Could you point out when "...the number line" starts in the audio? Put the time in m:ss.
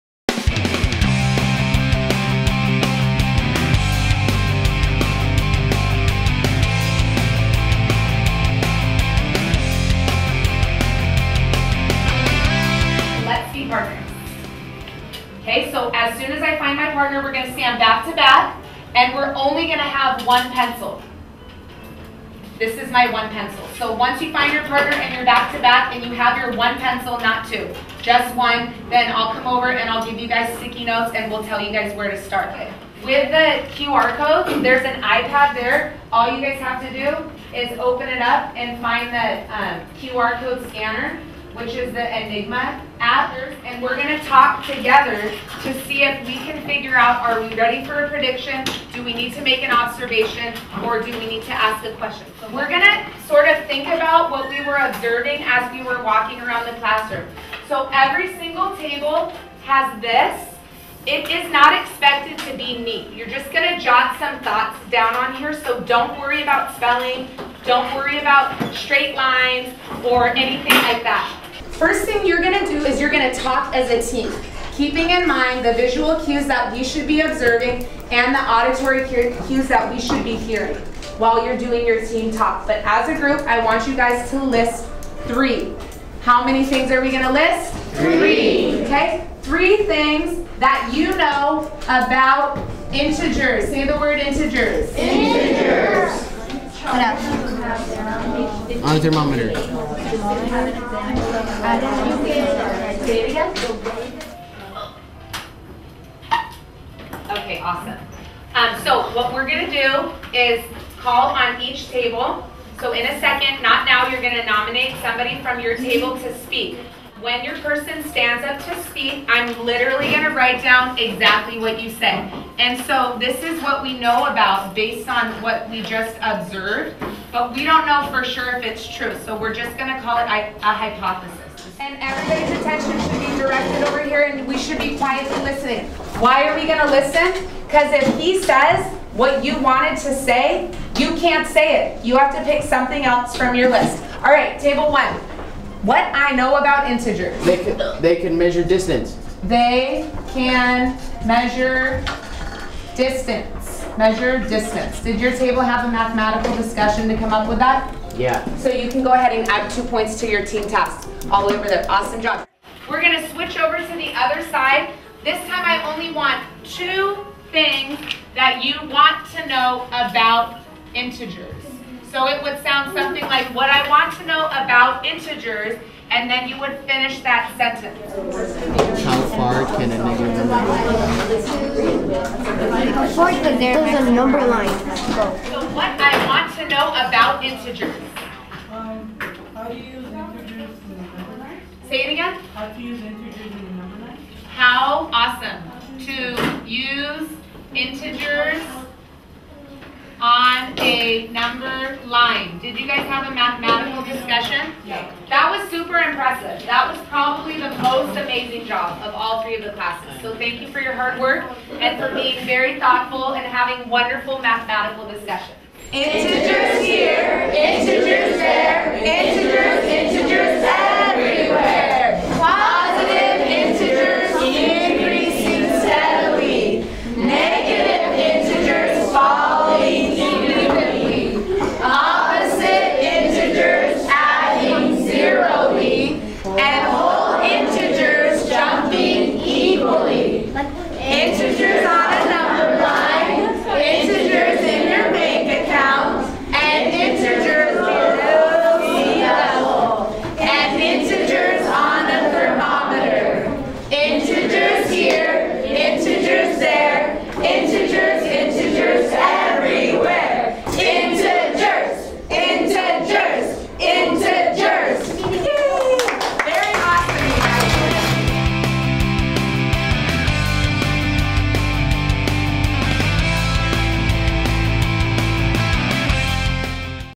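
3:13.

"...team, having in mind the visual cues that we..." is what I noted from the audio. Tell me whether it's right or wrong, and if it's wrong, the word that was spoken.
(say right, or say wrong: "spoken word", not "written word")
wrong: "keeping", not "having".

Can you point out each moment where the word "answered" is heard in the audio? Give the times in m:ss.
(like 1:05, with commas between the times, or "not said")
not said.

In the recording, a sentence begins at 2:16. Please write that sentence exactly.
Why are we going to listen?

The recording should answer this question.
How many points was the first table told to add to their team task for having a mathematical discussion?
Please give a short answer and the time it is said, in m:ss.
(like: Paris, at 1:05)
2, at 2:39.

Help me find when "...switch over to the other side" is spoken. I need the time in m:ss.
2:43.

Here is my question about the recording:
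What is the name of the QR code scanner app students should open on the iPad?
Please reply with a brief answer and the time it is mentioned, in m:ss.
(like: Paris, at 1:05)
i-nigma, at 0:42.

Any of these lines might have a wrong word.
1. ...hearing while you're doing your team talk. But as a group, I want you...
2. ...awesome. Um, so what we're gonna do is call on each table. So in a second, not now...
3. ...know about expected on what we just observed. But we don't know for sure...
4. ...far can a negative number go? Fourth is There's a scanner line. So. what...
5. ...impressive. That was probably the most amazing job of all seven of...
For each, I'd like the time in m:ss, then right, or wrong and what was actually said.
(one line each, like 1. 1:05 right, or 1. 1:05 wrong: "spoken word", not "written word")
1. 1:20 right
2. 1:47 right
3. 2:03 wrong: "based", not "expected"
4. 2:59 wrong: "number", not "scanner"
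5. 3:25 wrong: "three", not "seven".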